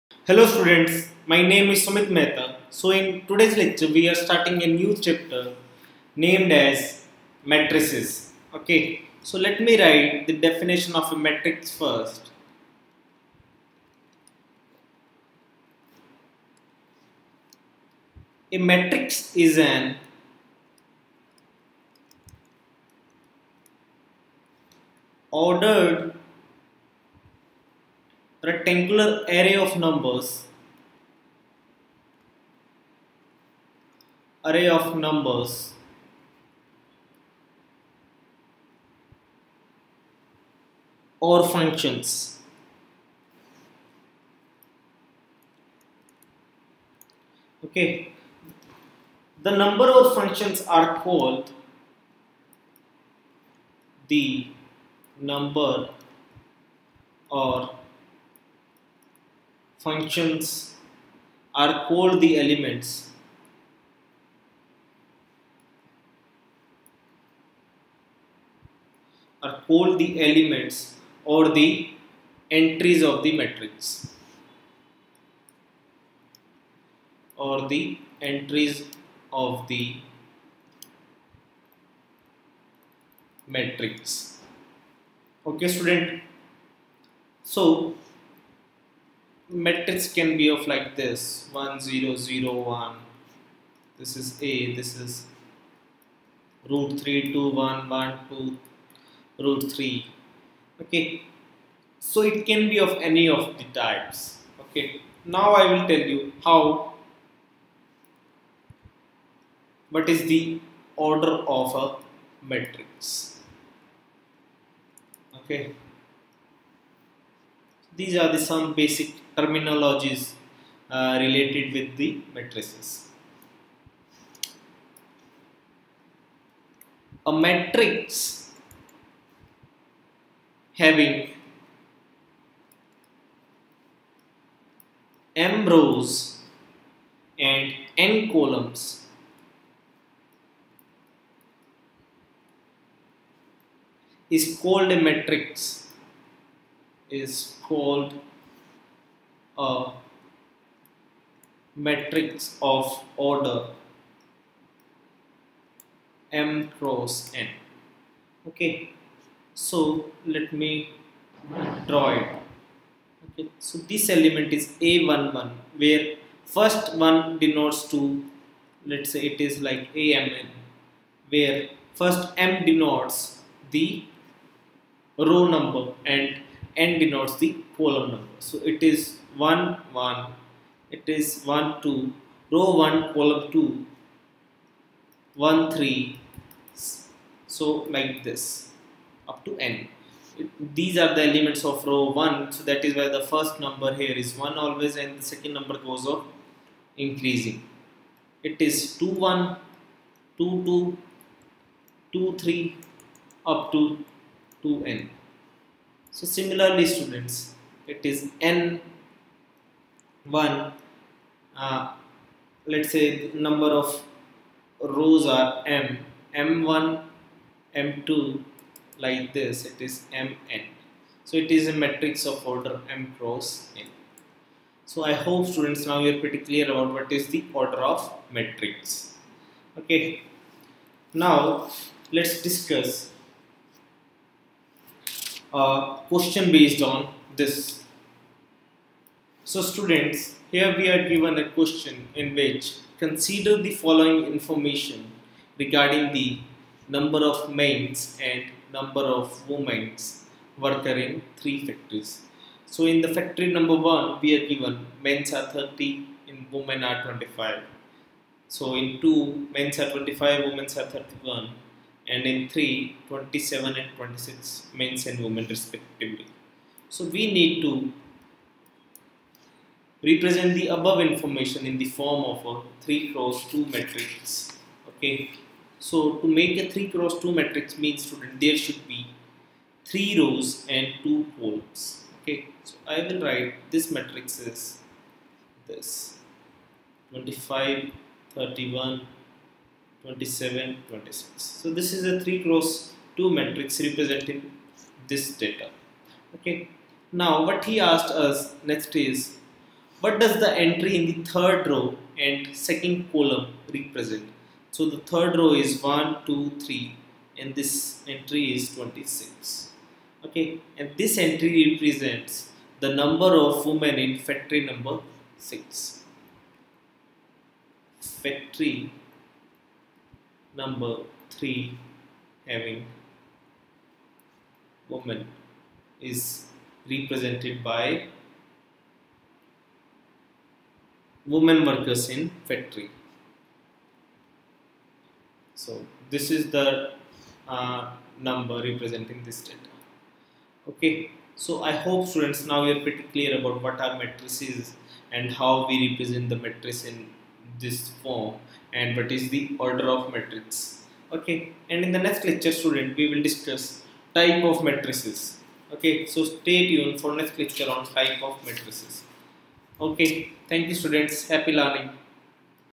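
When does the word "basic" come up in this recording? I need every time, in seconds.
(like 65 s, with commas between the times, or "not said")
118 s.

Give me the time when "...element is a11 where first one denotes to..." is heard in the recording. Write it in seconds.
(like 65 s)
164 s.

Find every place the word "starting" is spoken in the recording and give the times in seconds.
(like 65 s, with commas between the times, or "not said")
4 s.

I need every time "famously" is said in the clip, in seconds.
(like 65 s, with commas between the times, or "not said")
not said.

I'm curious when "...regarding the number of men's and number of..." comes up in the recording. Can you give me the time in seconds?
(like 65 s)
245 s.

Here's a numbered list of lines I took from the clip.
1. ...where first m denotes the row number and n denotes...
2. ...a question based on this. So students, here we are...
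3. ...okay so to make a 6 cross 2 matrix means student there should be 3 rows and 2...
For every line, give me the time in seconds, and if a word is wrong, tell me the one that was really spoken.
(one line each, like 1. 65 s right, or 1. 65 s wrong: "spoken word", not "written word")
1. 171 s right
2. 235 s right
3. 274 s wrong: "3", not "6".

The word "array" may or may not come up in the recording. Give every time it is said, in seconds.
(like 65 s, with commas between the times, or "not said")
29 s, 34 s.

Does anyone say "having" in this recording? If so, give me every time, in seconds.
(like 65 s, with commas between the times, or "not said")
130 s, 322 s.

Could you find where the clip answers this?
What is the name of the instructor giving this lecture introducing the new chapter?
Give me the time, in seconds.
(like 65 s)
1 s.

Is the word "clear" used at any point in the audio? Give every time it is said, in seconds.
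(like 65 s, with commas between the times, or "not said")
226 s, 343 s.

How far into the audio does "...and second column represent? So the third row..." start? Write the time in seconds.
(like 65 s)
302 s.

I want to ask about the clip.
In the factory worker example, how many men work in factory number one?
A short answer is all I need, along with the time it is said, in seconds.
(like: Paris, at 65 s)
30, at 255 s.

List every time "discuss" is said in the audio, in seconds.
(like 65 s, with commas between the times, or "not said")
232 s, 353 s.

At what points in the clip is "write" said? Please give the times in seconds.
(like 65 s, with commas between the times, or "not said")
9 s, 283 s.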